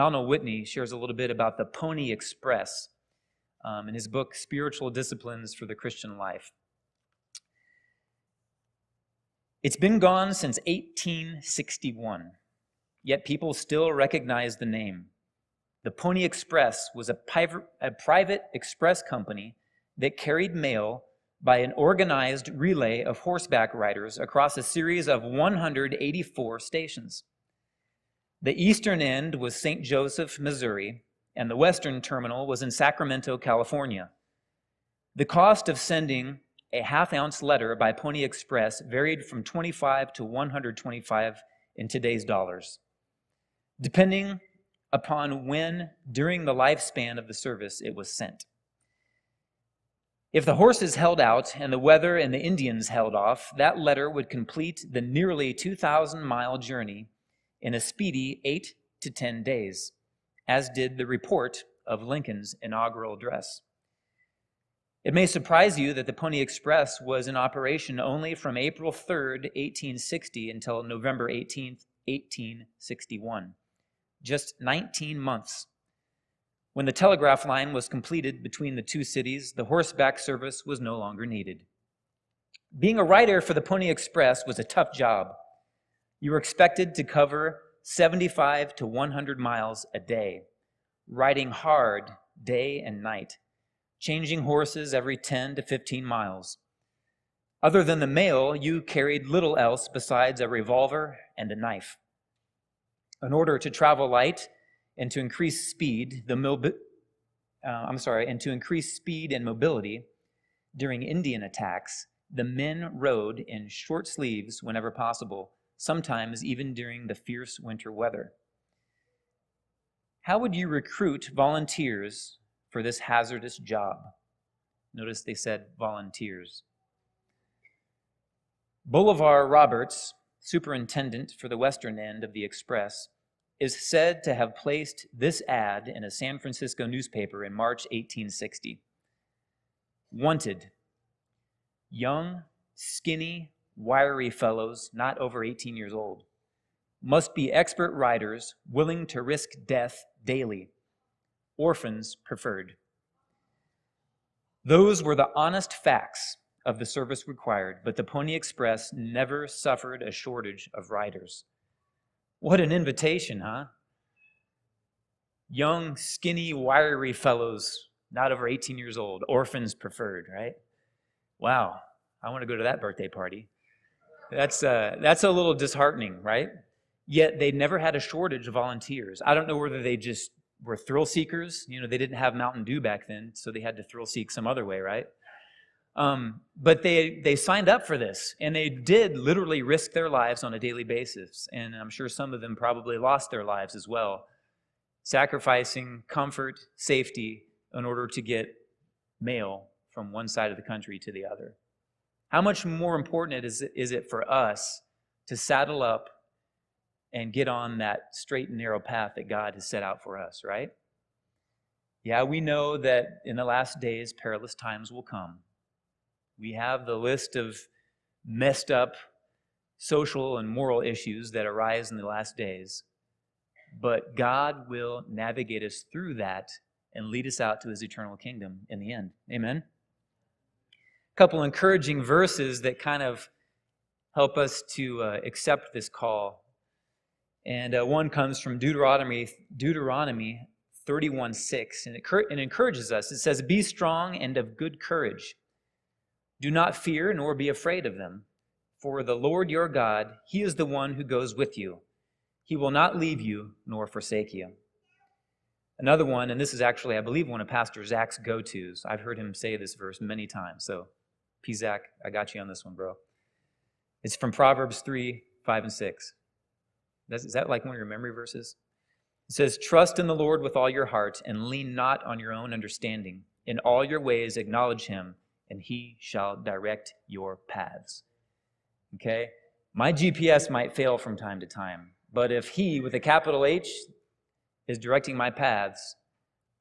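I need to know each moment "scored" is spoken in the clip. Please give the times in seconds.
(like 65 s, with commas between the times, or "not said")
not said.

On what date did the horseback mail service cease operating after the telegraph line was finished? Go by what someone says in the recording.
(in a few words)
November 18, 1861.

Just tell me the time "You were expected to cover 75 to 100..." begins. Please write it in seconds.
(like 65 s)
86 s.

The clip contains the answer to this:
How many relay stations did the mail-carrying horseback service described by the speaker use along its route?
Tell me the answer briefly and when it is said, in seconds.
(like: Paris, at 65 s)
184, at 25 s.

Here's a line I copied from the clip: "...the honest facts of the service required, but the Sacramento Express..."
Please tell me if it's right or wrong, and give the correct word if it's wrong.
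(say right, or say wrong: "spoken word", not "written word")
wrong: "Pony", not "Sacramento".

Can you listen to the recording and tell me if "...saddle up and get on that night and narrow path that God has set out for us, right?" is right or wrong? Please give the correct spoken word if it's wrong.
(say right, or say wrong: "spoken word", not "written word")
wrong: "straight", not "night".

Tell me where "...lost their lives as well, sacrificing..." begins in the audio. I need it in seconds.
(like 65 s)
192 s.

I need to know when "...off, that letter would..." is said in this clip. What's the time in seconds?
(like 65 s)
53 s.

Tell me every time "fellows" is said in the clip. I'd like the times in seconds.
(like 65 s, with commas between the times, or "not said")
144 s, 167 s.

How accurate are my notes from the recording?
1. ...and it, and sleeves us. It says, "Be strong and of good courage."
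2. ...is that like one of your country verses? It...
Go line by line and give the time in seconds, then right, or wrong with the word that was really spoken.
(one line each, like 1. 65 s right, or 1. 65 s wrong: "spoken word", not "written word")
1. 241 s wrong: "encourages", not "sleeves"
2. 267 s wrong: "memory", not "country".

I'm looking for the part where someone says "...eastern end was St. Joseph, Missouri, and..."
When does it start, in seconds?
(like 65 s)
28 s.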